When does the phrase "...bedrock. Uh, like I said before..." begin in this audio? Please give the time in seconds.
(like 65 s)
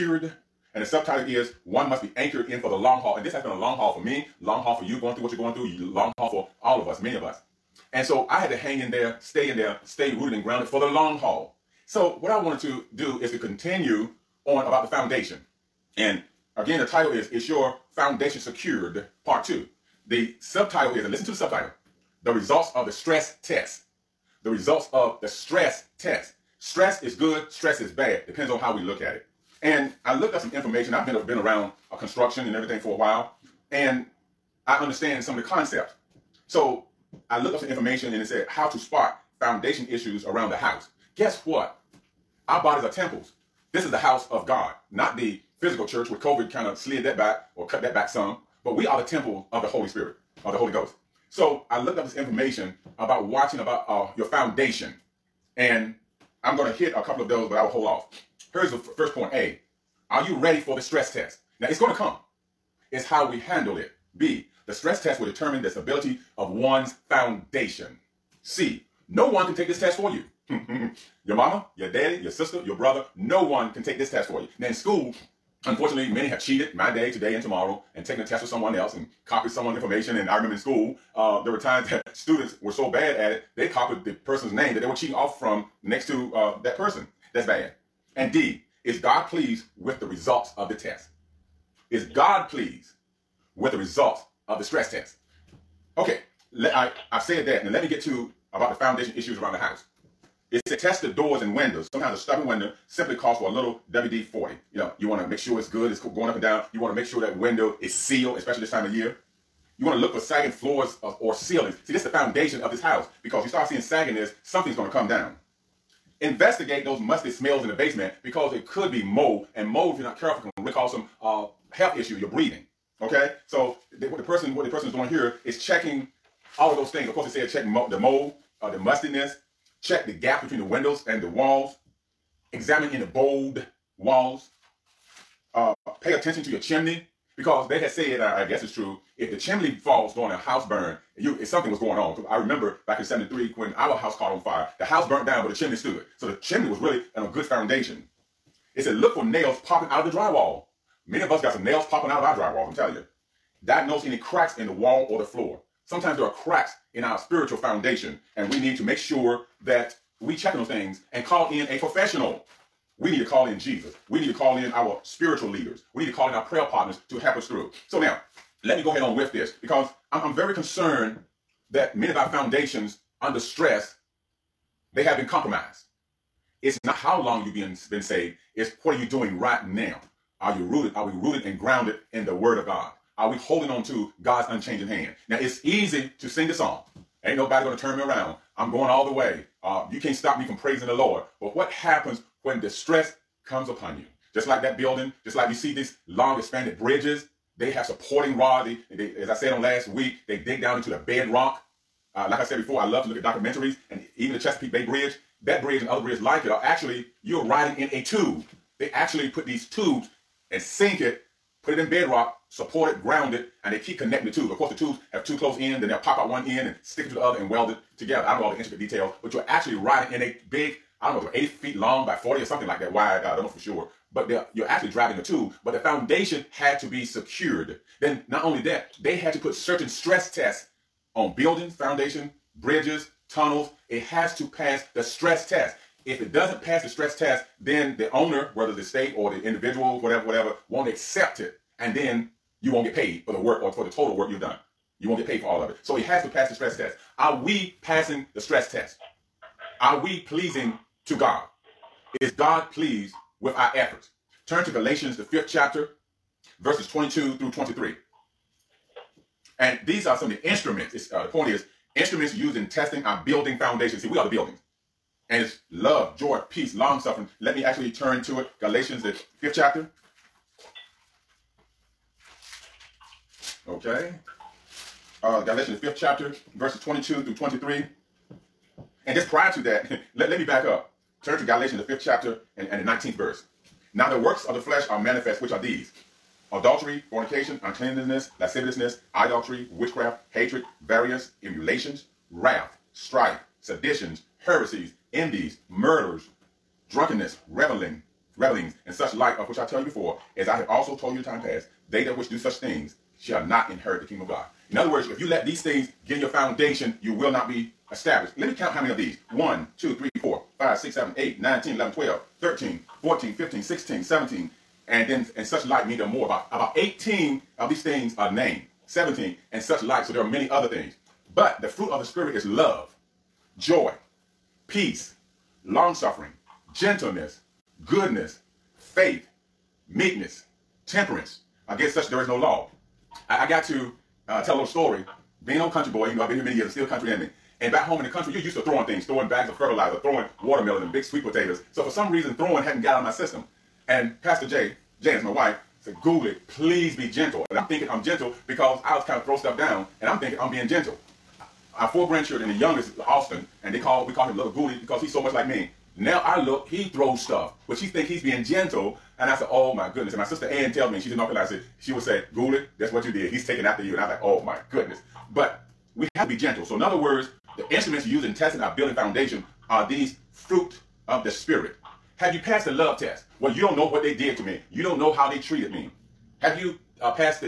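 201 s.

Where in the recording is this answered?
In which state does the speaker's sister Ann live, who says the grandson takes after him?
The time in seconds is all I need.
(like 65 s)
361 s.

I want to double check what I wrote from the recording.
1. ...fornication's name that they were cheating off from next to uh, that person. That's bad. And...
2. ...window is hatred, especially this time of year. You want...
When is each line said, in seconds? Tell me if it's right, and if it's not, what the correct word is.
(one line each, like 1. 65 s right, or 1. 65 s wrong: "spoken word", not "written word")
1. 84 s wrong: "person", not "fornication"
2. 107 s wrong: "sealed", not "hatred".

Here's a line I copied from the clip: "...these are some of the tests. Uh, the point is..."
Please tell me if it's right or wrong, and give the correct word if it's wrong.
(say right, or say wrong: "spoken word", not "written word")
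wrong: "instruments", not "tests".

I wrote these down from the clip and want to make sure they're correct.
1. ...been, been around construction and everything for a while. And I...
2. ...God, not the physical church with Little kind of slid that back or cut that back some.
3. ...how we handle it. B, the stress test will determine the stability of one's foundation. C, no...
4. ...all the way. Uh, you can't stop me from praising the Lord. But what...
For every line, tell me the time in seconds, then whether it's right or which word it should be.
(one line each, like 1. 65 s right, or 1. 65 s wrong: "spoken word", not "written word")
1. 31 s right
2. 44 s wrong: "COVID", not "Little"
3. 63 s right
4. 188 s right.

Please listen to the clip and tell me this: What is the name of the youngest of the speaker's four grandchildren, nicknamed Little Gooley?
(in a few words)
Austin.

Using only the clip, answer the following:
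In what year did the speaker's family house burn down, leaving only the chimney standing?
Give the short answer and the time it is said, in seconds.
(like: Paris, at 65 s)
1973, at 143 s.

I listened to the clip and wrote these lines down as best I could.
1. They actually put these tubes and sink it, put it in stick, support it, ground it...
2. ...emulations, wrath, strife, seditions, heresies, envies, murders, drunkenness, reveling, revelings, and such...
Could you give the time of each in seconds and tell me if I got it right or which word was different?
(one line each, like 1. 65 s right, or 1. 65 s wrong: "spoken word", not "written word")
1. 208 s wrong: "bedrock", not "stick"
2. 291 s right.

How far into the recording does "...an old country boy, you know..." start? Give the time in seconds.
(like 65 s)
335 s.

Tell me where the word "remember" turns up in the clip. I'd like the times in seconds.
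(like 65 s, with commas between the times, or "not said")
80 s, 142 s.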